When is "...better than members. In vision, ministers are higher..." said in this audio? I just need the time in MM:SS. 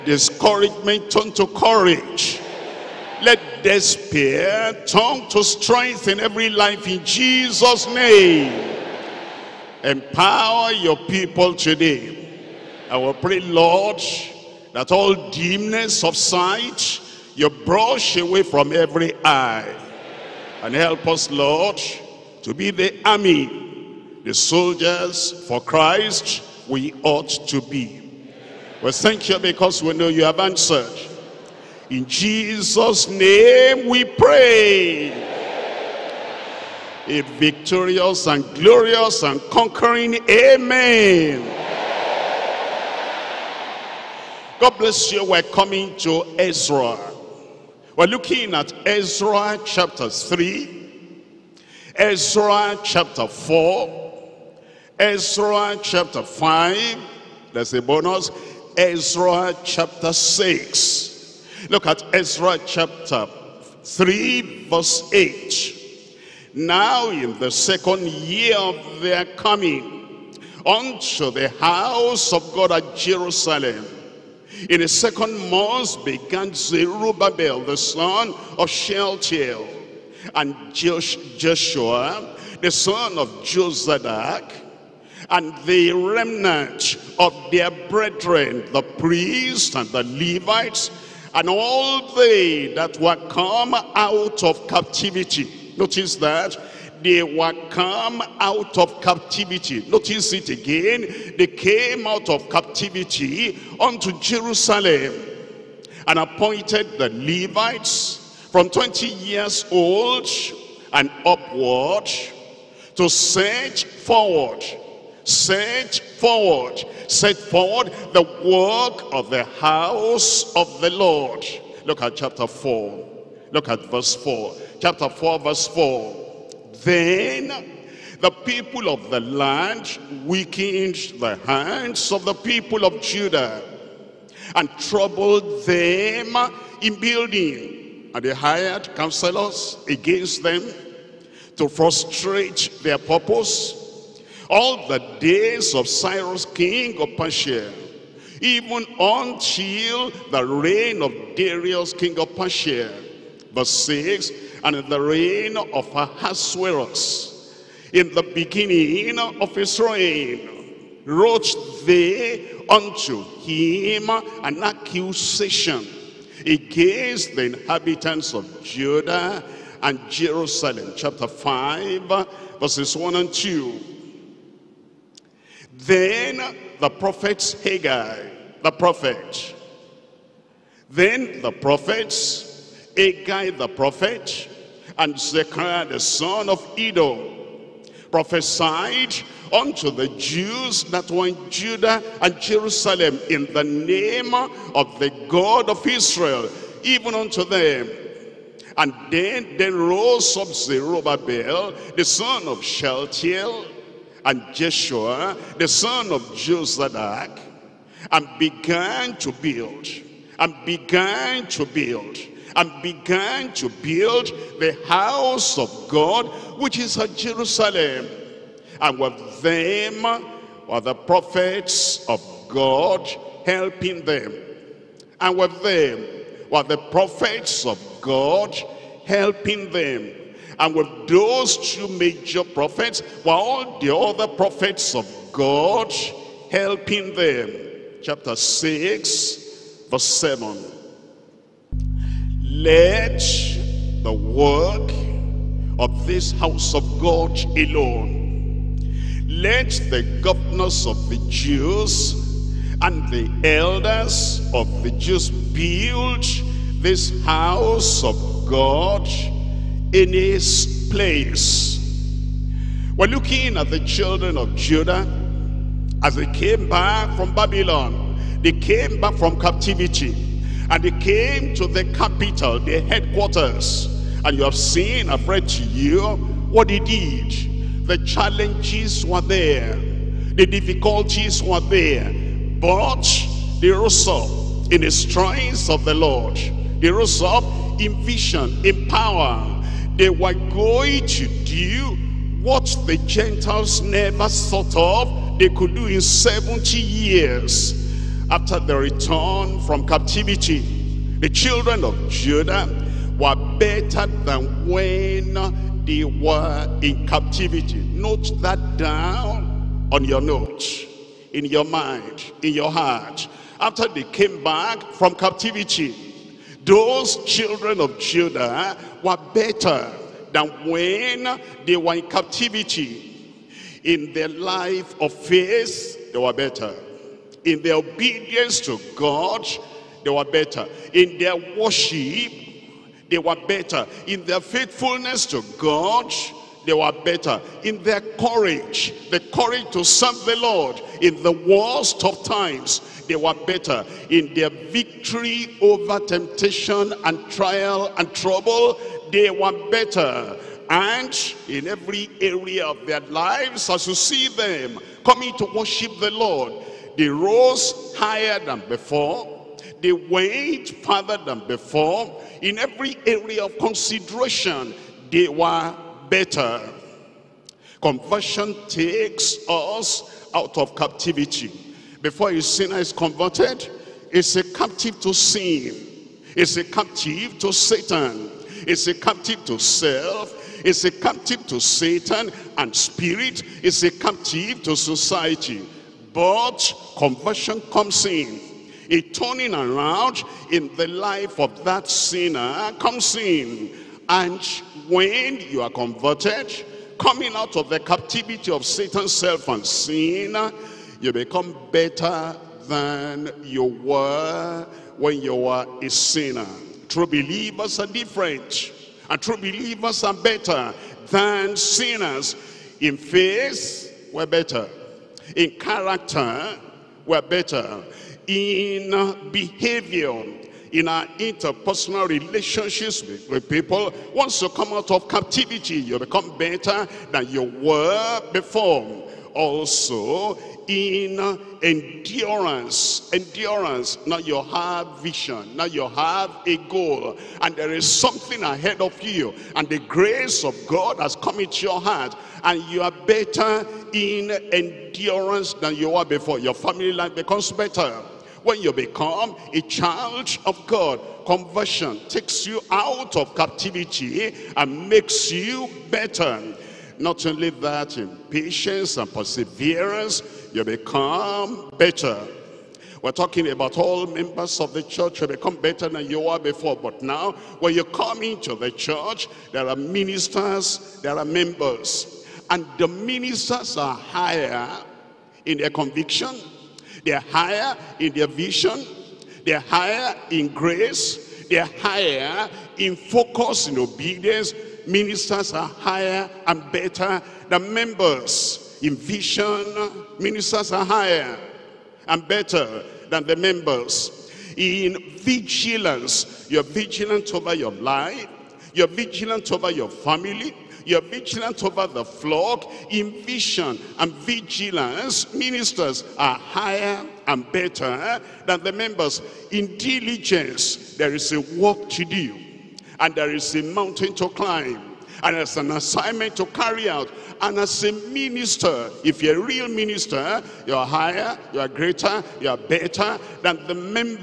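08:06.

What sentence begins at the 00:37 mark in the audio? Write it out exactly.
A victorious and glorious and conquering amen.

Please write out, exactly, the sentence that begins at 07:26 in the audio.
Your family life becomes better when you become a child of God.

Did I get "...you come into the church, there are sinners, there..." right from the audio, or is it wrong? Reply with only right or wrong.
wrong.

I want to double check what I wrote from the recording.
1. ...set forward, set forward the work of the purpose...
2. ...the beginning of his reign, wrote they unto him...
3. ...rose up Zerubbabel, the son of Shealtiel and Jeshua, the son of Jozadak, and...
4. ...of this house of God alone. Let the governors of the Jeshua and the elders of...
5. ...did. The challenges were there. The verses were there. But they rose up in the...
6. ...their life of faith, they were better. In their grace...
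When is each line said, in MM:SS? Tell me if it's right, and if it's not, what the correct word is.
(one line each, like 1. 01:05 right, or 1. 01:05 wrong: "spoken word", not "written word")
1. 01:55 wrong: "house", not "purpose"
2. 02:38 right
3. 03:19 right
4. 04:05 wrong: "Jews", not "Jeshua"
5. 04:36 wrong: "difficulties", not "verses"
6. 05:24 wrong: "obedience", not "grace".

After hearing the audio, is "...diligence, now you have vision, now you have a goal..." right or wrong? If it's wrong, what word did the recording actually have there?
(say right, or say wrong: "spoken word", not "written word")
wrong: "endurance", not "diligence".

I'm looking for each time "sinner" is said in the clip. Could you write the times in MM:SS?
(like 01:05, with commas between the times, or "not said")
06:12, 06:31, 06:45, 06:51.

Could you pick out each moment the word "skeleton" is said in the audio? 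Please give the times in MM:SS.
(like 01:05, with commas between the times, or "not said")
not said.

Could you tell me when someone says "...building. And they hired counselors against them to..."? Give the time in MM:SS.
02:17.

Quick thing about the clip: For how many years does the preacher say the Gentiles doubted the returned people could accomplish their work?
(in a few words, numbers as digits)
70.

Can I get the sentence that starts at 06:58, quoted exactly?
In behavior, in our interpersonal relationships with, with, people.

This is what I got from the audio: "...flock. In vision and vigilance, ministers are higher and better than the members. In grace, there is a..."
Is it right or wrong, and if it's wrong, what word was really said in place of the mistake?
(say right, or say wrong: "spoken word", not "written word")
wrong: "diligence", not "grace".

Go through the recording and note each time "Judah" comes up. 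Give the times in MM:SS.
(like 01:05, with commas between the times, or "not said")
02:13, 02:48, 03:11, 04:24, 05:02, 05:17.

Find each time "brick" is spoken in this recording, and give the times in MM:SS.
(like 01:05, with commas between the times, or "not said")
not said.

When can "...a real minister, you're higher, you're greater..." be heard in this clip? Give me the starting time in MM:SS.
08:39.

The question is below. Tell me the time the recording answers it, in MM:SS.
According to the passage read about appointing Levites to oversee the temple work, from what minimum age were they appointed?
01:48.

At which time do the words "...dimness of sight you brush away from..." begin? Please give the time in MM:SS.
00:15.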